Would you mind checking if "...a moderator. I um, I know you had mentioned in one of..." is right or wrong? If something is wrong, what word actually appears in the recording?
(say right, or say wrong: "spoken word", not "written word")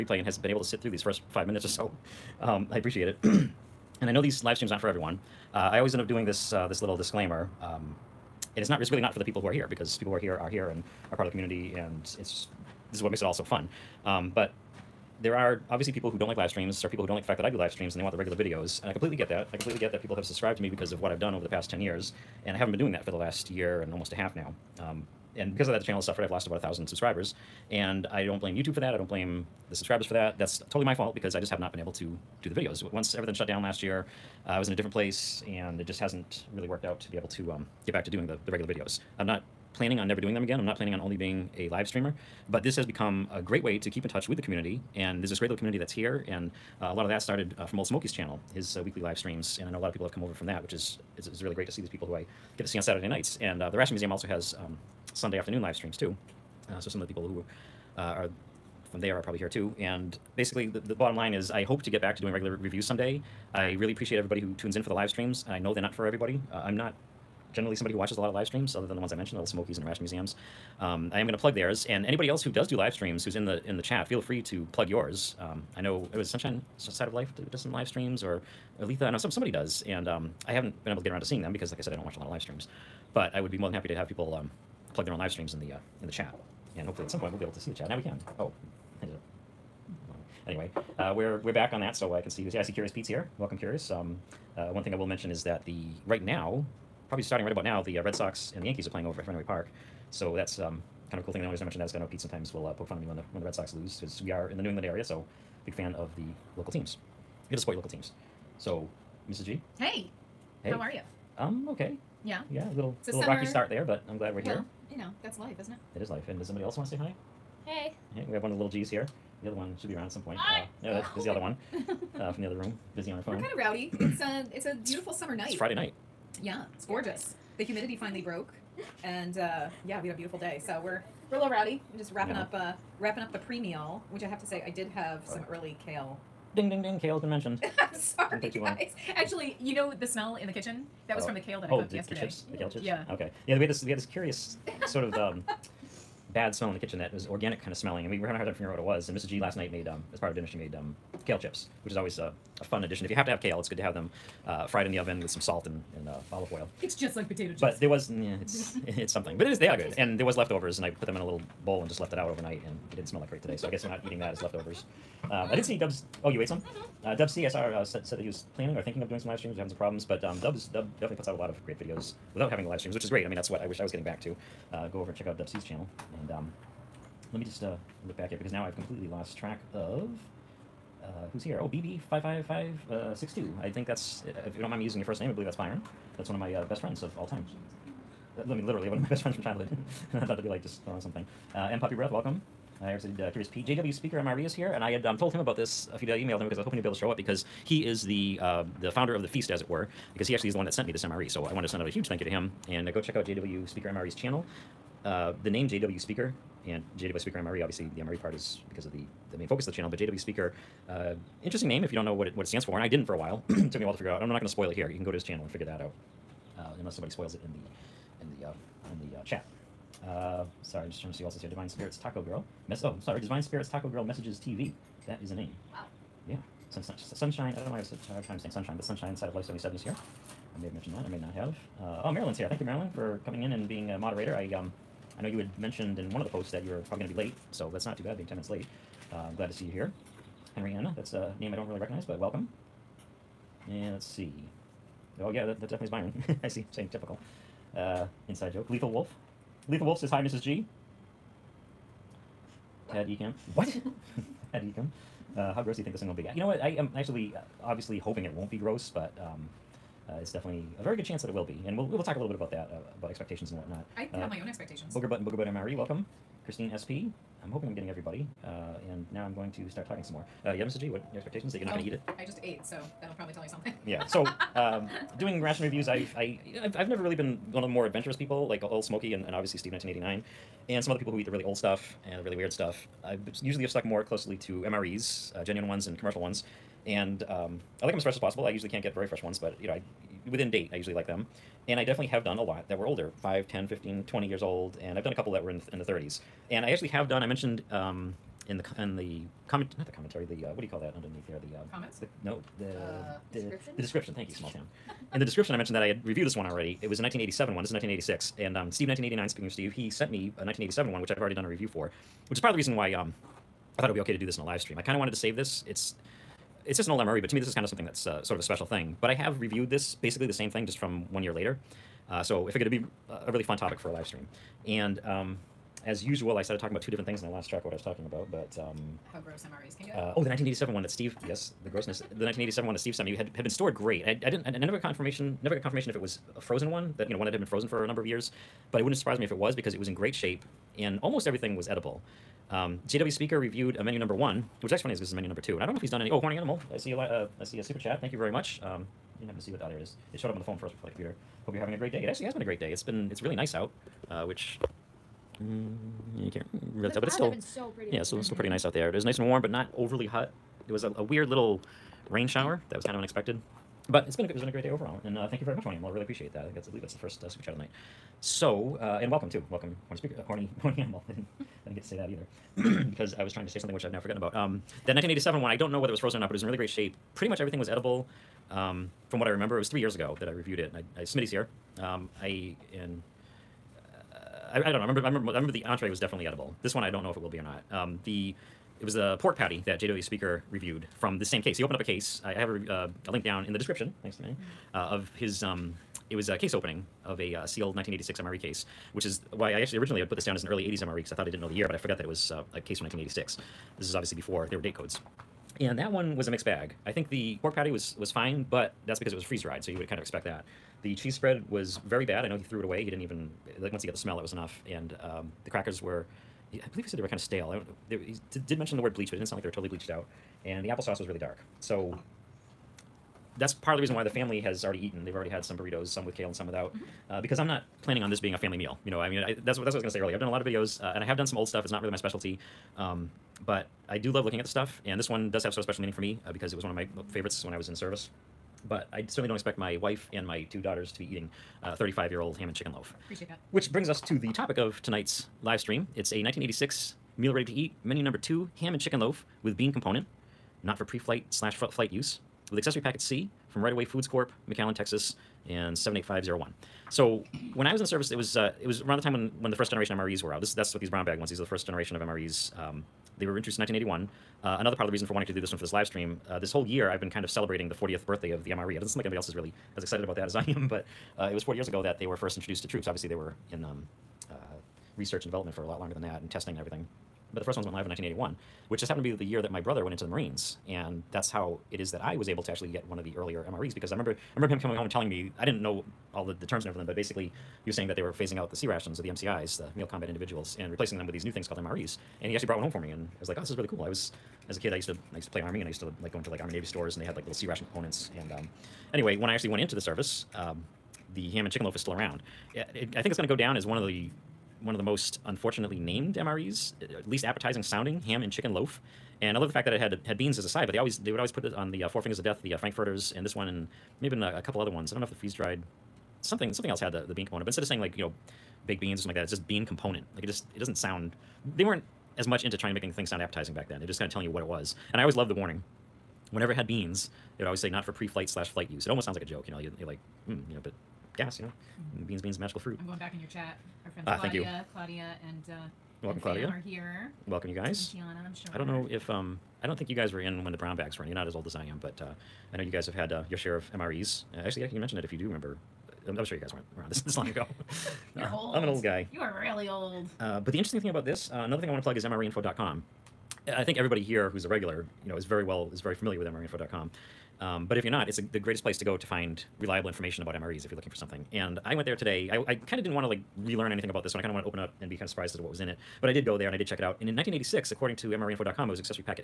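right.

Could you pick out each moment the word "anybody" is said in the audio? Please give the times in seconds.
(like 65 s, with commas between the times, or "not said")
72 s, 469 s.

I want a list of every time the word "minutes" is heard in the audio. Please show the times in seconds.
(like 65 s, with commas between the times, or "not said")
1 s, 238 s.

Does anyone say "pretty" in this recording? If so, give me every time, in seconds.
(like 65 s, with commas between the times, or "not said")
358 s, 377 s.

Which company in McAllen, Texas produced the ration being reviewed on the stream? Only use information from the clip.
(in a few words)
Right Away Foods Corp.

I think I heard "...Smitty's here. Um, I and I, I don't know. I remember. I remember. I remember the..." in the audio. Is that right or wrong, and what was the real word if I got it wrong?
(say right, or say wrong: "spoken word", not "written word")
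right.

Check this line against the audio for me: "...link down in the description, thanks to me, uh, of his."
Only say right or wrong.
right.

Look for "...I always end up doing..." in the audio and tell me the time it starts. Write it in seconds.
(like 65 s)
5 s.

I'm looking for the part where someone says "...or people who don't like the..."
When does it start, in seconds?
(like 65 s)
16 s.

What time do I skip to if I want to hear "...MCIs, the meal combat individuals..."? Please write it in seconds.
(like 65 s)
489 s.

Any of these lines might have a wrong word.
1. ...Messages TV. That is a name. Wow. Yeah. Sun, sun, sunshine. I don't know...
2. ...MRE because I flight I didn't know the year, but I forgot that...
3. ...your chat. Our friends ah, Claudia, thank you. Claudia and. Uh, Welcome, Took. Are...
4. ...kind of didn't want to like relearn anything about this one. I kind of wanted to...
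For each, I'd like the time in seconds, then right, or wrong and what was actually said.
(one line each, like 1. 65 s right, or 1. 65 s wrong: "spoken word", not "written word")
1. 224 s right
2. 400 s wrong: "thought", not "flight"
3. 533 s wrong: "Claudia", not "Took"
4. 562 s right.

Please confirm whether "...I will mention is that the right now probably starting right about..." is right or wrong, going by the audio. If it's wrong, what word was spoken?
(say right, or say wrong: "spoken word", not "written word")
right.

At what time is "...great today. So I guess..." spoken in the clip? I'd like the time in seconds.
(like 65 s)
163 s.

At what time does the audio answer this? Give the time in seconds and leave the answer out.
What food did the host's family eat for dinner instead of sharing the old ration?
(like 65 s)
425 s.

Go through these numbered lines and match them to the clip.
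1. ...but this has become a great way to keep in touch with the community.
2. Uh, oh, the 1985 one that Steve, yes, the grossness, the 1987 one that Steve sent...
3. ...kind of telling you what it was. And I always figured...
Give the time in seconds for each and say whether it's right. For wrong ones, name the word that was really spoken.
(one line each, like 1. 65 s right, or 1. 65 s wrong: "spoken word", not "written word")
1. 42 s right
2. 329 s wrong: "1987", not "1985"
3. 523 s wrong: "loved", not "figured".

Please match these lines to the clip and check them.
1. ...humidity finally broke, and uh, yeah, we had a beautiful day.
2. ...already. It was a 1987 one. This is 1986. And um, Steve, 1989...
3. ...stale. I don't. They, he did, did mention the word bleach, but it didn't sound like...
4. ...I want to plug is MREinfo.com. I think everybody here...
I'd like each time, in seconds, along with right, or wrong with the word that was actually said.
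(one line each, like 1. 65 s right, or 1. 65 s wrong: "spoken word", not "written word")
1. 127 s right
2. 306 s right
3. 417 s right
4. 551 s right.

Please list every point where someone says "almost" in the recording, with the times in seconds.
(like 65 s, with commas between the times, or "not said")
23 s, 341 s, 528 s.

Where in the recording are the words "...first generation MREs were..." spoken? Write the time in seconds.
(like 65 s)
459 s.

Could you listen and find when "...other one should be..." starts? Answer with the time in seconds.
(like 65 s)
119 s.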